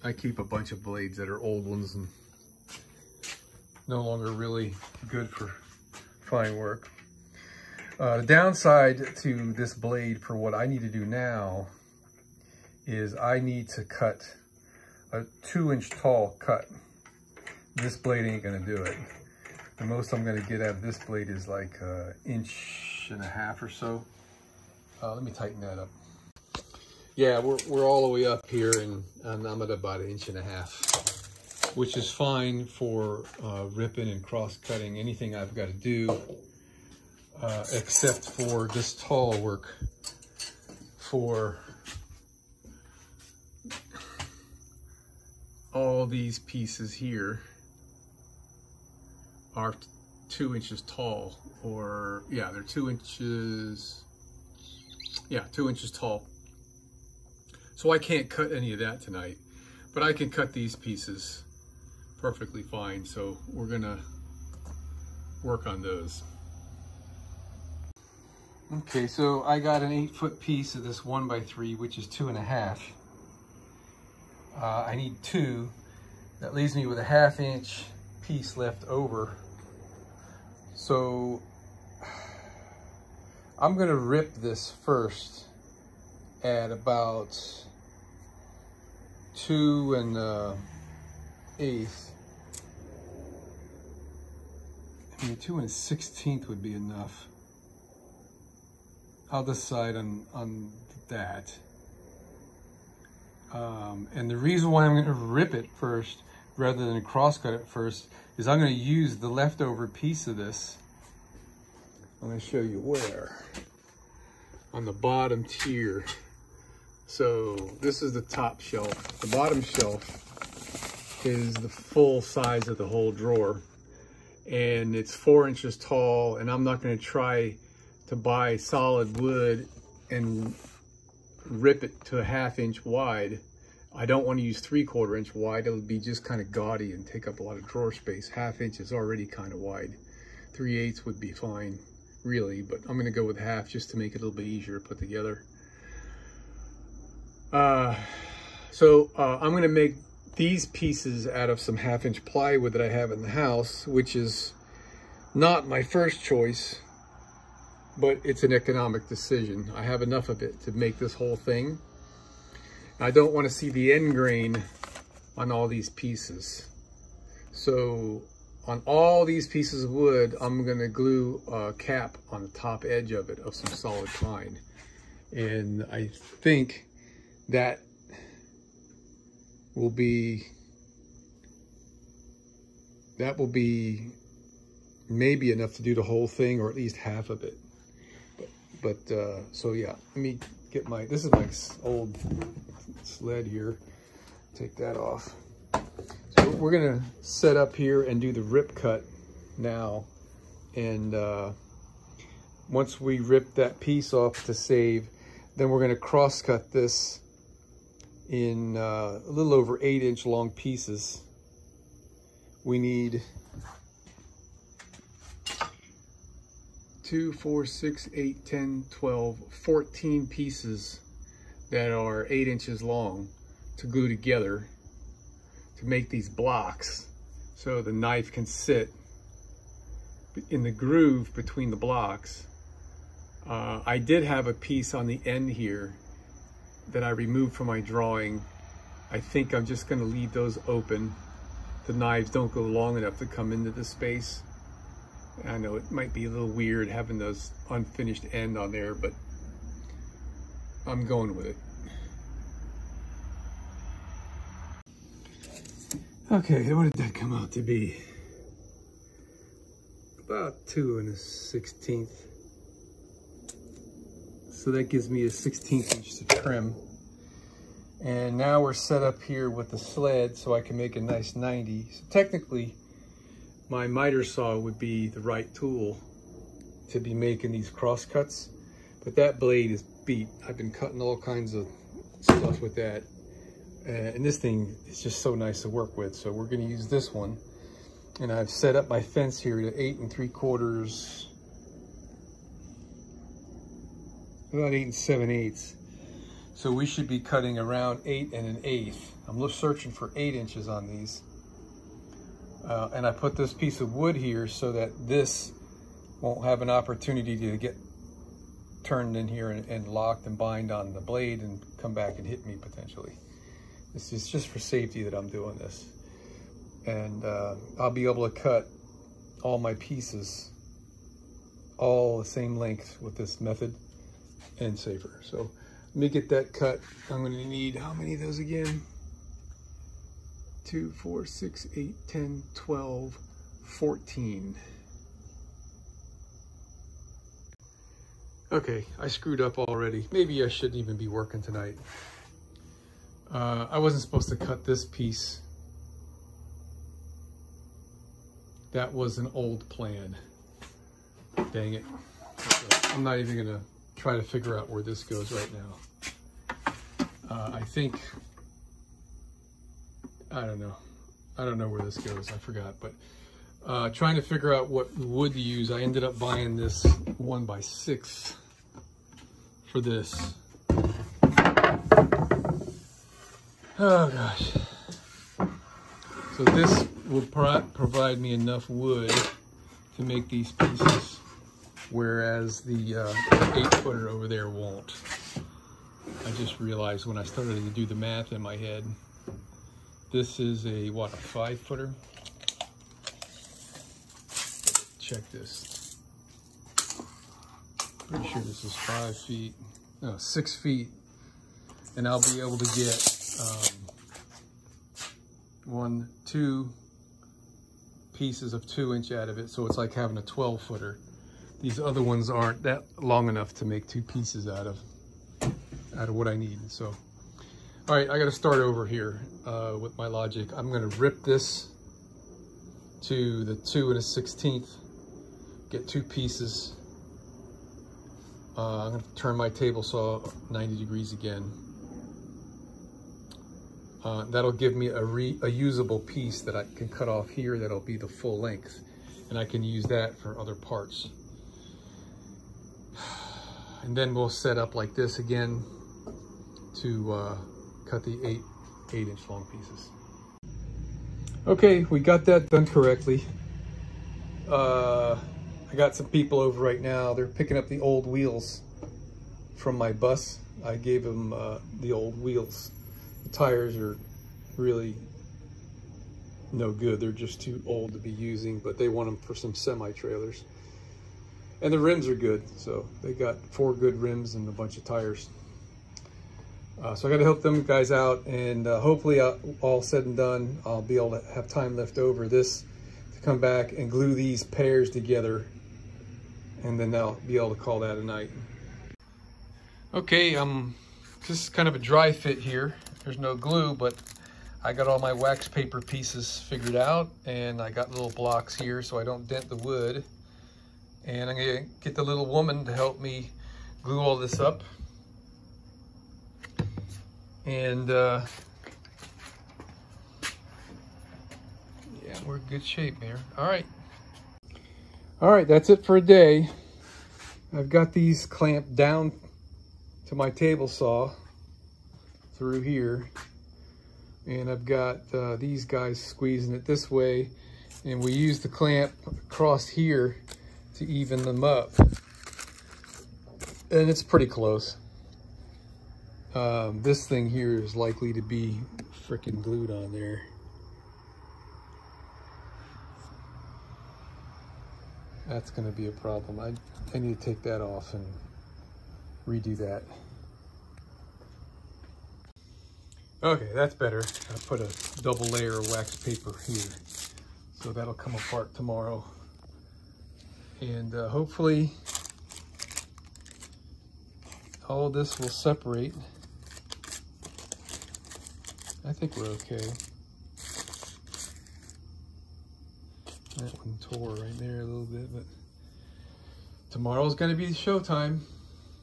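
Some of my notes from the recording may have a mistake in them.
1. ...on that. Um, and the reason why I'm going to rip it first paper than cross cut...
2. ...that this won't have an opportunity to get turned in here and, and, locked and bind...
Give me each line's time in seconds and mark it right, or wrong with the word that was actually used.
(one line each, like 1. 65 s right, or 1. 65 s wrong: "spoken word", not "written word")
1. 100 s wrong: "rather", not "paper"
2. 304 s right.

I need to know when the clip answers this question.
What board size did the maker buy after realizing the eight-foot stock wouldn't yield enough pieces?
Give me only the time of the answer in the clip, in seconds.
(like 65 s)
367 s.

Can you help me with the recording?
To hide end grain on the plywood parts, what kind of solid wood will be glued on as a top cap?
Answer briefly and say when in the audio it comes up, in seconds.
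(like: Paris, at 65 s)
pine, at 174 s.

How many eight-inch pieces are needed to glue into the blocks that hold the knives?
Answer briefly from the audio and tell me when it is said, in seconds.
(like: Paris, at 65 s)
14, at 219 s.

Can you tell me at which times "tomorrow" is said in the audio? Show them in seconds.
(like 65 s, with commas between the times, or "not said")
558 s, 576 s.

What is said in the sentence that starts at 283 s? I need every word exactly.
Uh, and this thing is just so nice to work with.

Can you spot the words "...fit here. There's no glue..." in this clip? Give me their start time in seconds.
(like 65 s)
492 s.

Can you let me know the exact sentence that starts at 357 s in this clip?
Uh, I think I don't know.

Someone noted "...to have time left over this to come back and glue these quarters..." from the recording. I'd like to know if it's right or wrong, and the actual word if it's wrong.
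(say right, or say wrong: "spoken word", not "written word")
wrong: "pairs", not "quarters".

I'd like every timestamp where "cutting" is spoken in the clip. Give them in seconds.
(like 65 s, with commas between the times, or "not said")
34 s, 280 s, 297 s.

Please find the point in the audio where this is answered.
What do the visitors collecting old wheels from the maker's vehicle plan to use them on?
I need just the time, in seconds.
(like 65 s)
469 s.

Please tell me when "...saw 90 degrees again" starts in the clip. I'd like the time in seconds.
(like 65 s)
429 s.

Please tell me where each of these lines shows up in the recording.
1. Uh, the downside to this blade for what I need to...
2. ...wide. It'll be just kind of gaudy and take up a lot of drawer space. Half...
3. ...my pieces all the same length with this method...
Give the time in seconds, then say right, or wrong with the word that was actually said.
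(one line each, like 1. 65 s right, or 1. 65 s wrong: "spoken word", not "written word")
1. 7 s right
2. 135 s right
3. 319 s right.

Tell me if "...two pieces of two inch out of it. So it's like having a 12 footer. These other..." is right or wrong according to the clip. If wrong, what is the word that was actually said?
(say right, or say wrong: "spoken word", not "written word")
right.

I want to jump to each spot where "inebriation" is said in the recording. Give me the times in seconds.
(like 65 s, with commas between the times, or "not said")
not said.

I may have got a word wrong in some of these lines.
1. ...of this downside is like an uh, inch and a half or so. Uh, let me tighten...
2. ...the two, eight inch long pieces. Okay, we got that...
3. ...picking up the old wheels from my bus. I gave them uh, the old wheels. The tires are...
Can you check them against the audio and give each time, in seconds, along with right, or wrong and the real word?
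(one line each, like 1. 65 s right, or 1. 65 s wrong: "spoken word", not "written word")
1. 20 s wrong: "blade", not "downside"
2. 448 s wrong: "eight", not "two"
3. 457 s right.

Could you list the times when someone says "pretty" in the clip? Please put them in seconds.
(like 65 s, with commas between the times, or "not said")
398 s, 534 s.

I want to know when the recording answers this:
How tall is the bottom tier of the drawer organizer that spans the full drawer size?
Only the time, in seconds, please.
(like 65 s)
125 s.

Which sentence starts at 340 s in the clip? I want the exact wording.
Maybe I shouldn't even be working tonight.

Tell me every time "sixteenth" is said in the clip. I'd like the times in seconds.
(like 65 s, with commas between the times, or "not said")
95 s, 261 s, 424 s.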